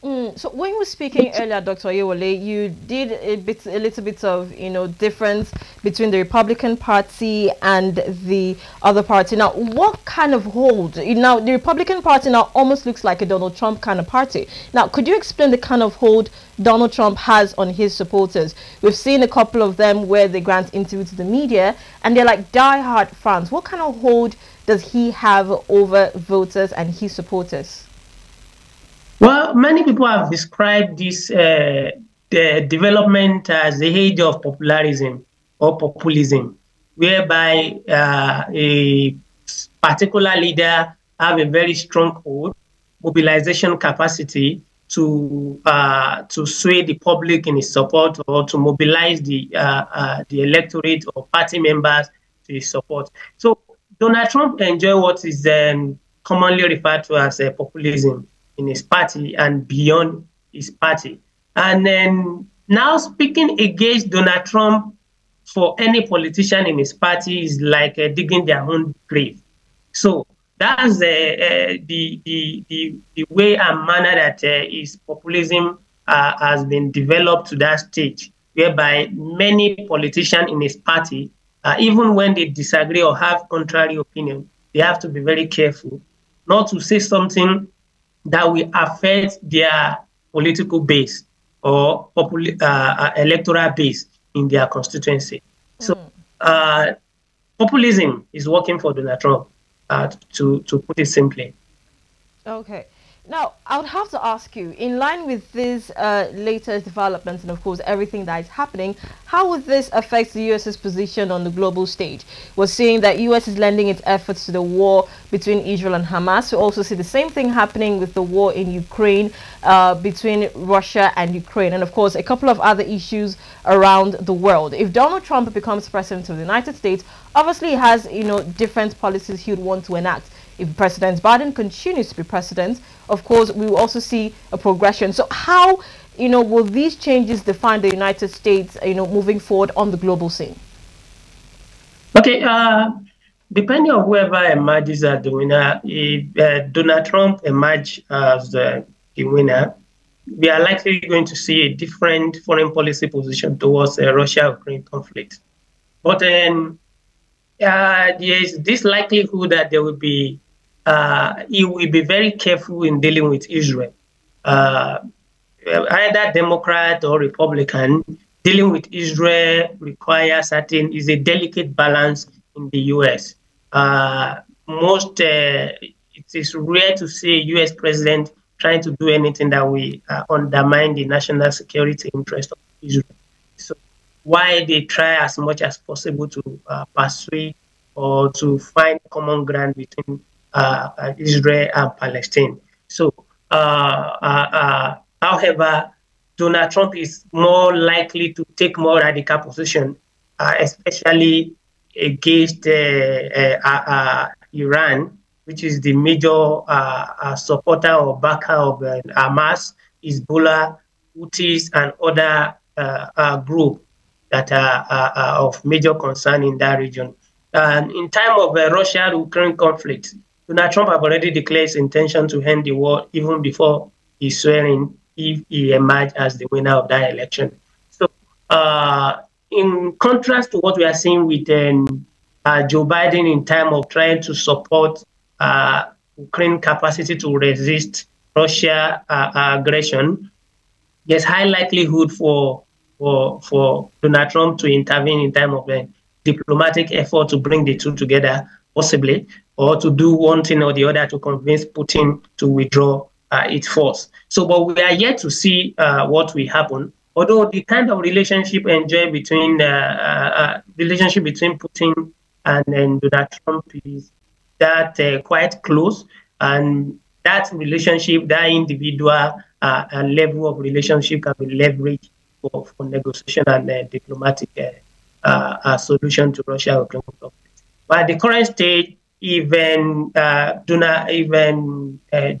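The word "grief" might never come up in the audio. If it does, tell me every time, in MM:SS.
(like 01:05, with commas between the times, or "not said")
not said.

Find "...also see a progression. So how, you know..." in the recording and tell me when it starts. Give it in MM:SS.
02:13.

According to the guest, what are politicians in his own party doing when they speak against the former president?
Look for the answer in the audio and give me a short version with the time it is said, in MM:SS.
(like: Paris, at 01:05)
Digging their own grave, at 01:08.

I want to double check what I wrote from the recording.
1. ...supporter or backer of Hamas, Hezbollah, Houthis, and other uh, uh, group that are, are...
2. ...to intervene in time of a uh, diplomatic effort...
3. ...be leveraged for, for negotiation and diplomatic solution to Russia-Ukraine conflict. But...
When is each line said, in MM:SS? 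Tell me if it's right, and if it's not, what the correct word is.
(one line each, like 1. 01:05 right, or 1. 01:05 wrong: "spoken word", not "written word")
1. 03:27 right
2. 04:04 right
3. 04:31 right.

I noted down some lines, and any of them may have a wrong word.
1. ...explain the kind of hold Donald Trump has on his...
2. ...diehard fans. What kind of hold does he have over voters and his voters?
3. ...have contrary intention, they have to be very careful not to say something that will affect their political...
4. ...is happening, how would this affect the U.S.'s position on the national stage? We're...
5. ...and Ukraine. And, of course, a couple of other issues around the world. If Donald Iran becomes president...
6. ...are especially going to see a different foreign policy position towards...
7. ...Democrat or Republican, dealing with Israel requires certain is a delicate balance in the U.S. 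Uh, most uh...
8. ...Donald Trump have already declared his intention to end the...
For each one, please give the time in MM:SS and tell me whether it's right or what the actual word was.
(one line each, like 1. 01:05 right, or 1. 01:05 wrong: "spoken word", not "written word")
1. 00:15 right
2. 00:22 wrong: "supporters", not "voters"
3. 01:23 wrong: "opinion", not "intention"
4. 01:48 wrong: "global", not "national"
5. 02:01 wrong: "Trump", not "Iran"
6. 02:30 wrong: "likely", not "especially"
7. 02:46 right
8. 03:40 right.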